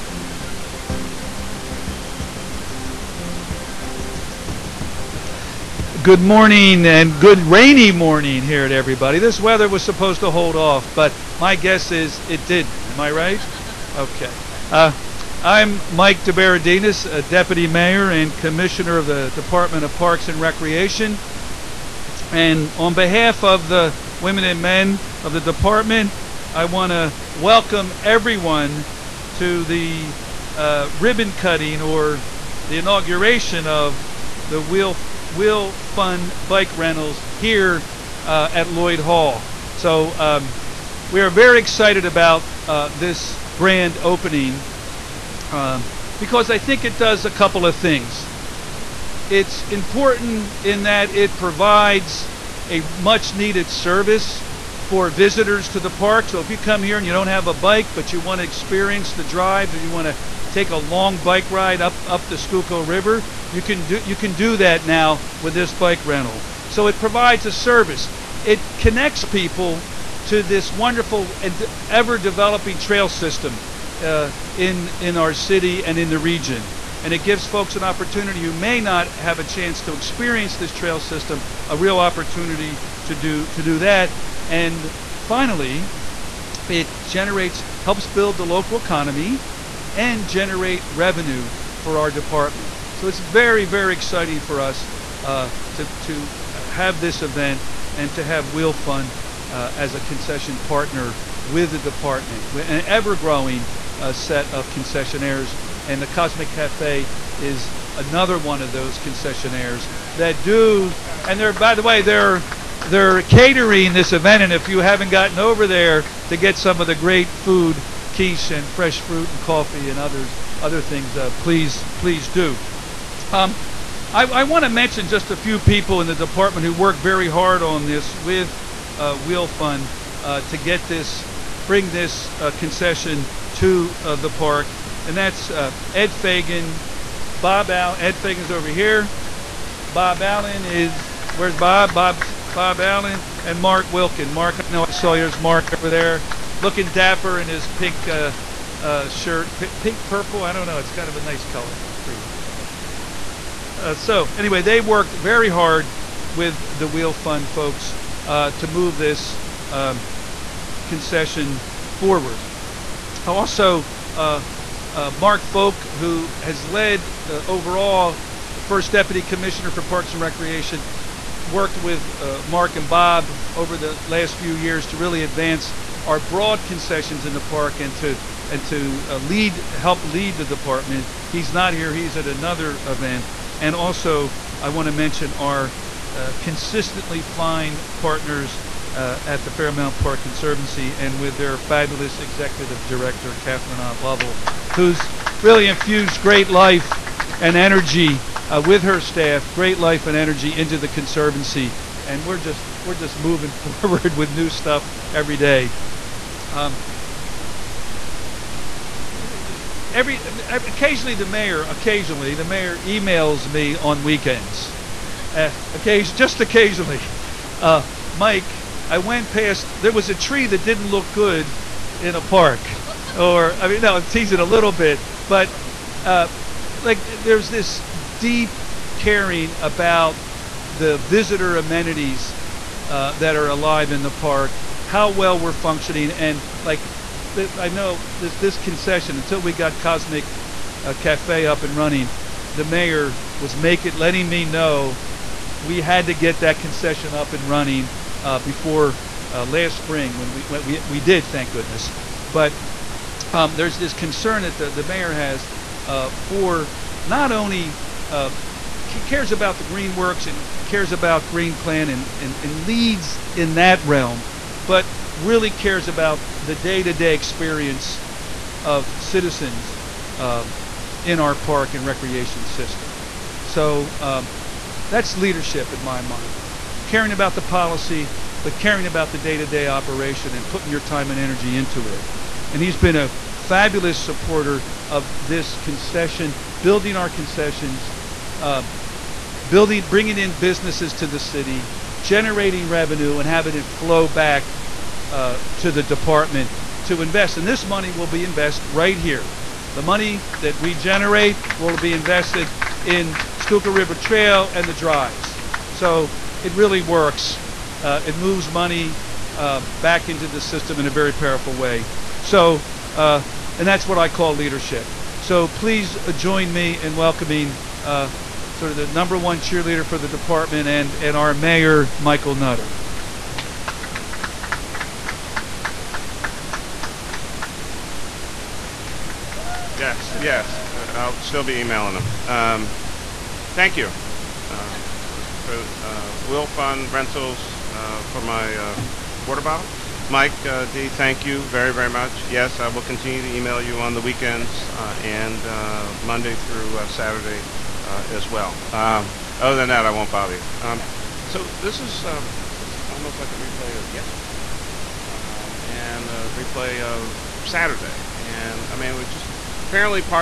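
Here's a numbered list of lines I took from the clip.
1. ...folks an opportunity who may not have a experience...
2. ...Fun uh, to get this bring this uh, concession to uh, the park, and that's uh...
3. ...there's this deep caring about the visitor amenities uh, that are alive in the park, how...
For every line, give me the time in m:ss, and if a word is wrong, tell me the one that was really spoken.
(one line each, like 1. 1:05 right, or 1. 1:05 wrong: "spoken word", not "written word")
1. 1:17 wrong: "chance", not "experience"
2. 2:09 right
3. 3:47 right.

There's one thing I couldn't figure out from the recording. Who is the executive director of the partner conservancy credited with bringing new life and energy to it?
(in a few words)
Catherine Ott Lovell.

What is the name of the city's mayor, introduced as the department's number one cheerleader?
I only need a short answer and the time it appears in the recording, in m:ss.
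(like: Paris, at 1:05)
Michael Nutter, at 5:21.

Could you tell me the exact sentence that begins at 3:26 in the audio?
Um, every, occasionally the mayor occasionally the mayor emails me on weekends, uh, occasion, just occasionally.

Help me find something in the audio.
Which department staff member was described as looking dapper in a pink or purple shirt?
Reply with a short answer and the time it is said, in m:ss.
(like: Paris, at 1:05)
Mark Wilkin, at 2:23.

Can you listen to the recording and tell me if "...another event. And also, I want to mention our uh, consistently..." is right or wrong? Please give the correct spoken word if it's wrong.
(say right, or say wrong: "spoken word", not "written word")
right.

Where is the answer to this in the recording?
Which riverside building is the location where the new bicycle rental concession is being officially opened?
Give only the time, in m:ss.
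0:38.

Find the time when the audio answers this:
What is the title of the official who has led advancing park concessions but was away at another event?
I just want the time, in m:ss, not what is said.
2:48.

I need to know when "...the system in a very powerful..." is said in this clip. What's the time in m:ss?
5:10.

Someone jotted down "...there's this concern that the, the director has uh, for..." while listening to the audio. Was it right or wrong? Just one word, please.
wrong.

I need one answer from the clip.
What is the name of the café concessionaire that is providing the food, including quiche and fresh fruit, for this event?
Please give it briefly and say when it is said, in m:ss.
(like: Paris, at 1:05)
Cosmic Cafe, at 1:46.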